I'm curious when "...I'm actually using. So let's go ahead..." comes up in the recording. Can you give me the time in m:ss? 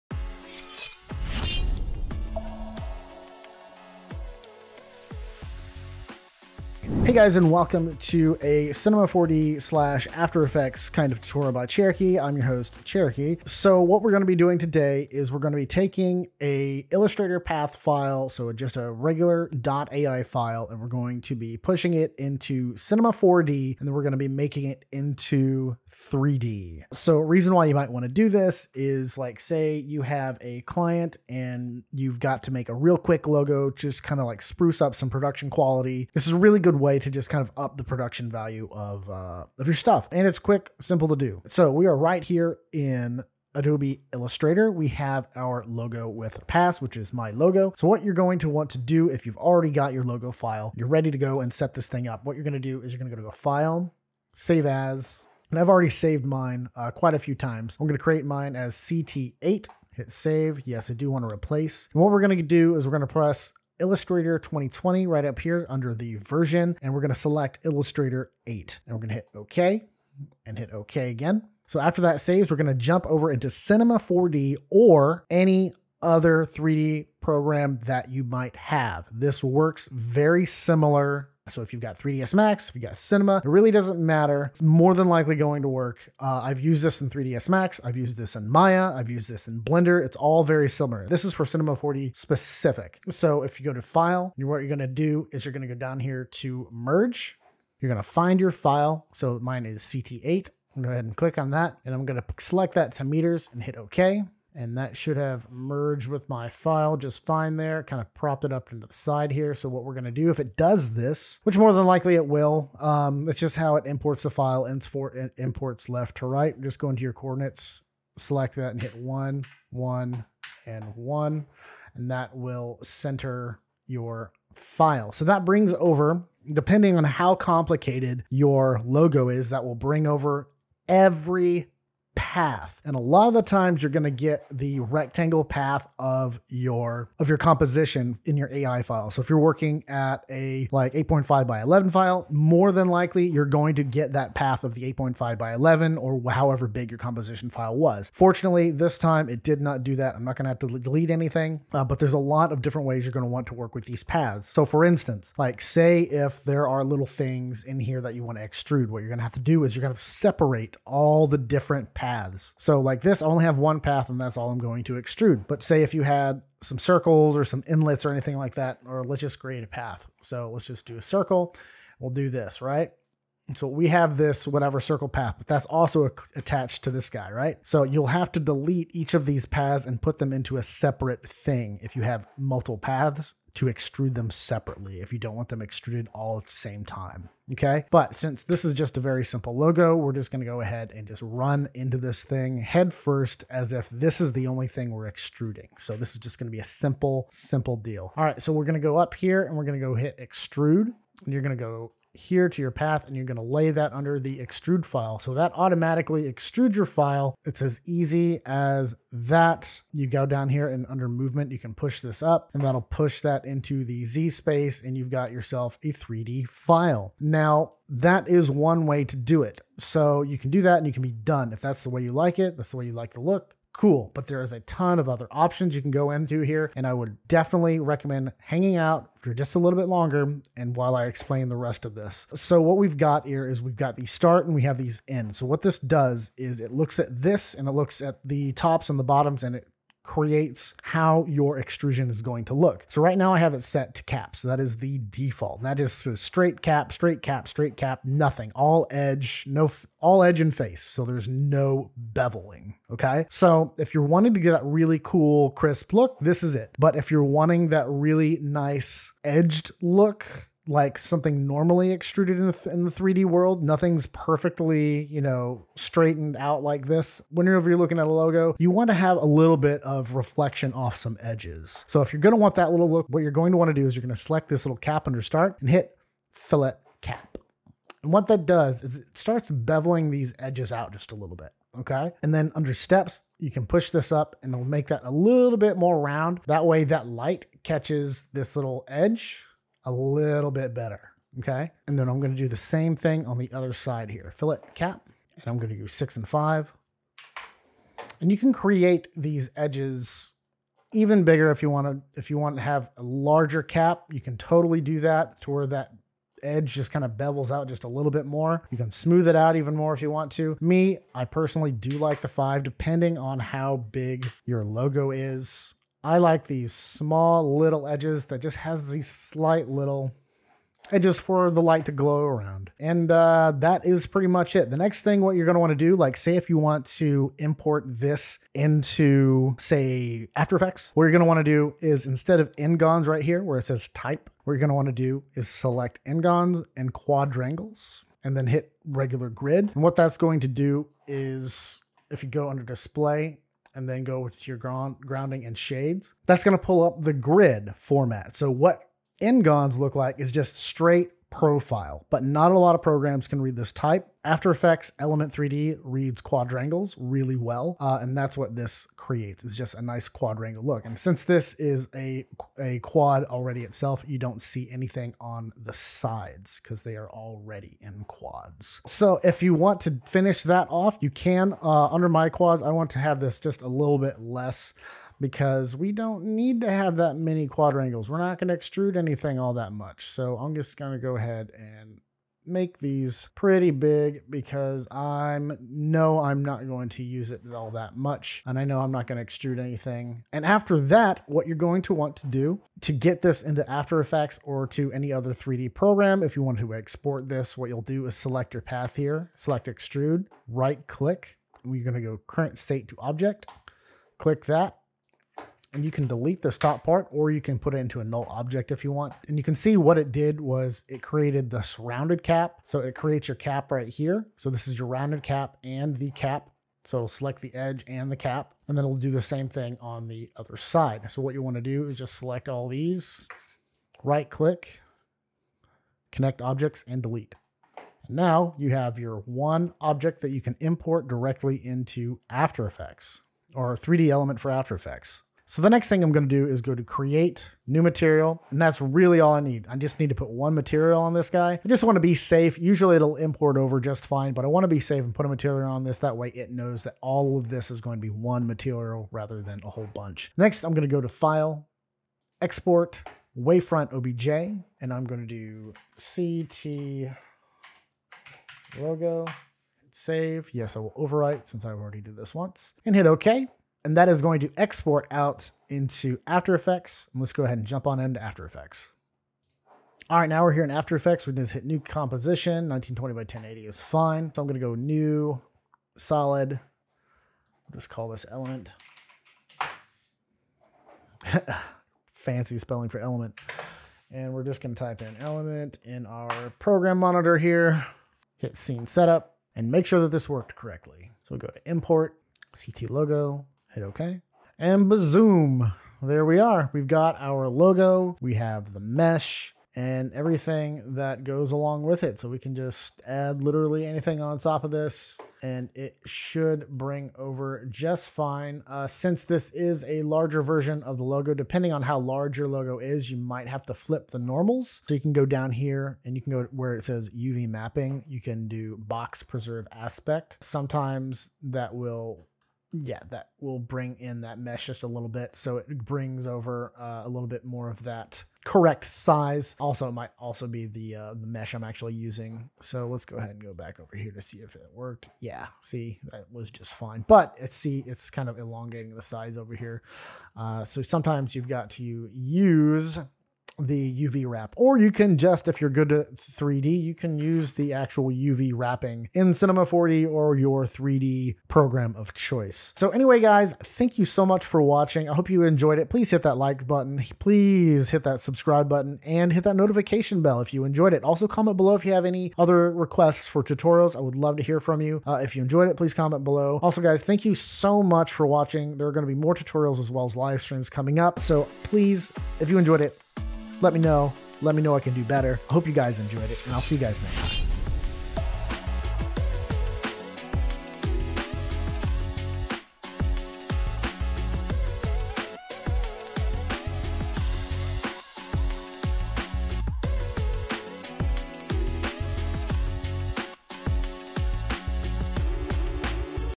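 8:51.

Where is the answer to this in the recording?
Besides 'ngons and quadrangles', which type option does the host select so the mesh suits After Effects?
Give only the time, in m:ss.
5:38.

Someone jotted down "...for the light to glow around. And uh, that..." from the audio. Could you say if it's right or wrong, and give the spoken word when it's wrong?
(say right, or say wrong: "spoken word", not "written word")
right.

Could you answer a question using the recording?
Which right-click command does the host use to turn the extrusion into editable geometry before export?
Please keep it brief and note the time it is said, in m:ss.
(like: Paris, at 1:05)
current state to object, at 6:42.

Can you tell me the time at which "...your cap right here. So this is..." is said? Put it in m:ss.
6:53.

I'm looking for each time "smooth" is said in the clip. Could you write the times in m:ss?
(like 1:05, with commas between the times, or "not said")
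5:08.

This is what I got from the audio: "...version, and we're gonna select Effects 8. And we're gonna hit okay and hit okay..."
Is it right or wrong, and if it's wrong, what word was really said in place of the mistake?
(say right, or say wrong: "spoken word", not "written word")
wrong: "Illustrator", not "Effects".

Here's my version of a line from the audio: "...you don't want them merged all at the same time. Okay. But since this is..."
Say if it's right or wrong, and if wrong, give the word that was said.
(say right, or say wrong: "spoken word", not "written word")
wrong: "extruded", not "merged".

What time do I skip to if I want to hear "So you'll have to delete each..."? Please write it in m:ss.
2:57.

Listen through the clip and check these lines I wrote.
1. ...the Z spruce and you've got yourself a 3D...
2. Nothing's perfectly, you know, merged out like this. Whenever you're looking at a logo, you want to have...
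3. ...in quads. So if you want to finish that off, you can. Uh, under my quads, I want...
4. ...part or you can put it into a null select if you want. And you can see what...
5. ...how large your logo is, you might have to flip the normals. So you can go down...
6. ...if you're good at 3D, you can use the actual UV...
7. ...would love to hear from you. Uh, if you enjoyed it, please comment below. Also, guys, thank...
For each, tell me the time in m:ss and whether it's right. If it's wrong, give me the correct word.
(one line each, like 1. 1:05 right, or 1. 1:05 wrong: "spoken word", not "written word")
1. 3:33 wrong: "space", not "spruce"
2. 4:23 wrong: "straightened", not "merged"
3. 6:07 right
4. 6:46 wrong: "object", not "select"
5. 8:31 right
6. 9:05 right
7. 9:23 right.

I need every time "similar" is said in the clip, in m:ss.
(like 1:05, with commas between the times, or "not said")
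1:20, 1:30.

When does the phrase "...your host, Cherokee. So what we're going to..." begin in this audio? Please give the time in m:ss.
0:12.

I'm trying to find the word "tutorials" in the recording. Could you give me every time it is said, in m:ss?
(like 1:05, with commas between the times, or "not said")
0:11, 9:23, 9:29.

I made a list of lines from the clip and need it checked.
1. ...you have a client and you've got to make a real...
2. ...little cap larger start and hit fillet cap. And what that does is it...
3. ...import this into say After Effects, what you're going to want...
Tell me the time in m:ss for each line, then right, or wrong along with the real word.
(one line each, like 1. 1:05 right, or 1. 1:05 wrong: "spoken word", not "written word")
1. 0:29 right
2. 4:34 wrong: "under", not "larger"
3. 5:27 right.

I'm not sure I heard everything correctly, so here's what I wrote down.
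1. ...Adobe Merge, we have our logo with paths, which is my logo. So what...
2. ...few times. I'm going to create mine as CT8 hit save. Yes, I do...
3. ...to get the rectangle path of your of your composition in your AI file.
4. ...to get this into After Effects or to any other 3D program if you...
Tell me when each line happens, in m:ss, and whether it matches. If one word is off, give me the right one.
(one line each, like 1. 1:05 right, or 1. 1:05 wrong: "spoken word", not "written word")
1. 0:43 wrong: "Illustrator", not "Merge"
2. 0:57 right
3. 2:14 right
4. 6:32 right.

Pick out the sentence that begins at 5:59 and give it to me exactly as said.
It's just a nice quadrangle look.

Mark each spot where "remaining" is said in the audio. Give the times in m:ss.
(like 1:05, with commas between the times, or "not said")
not said.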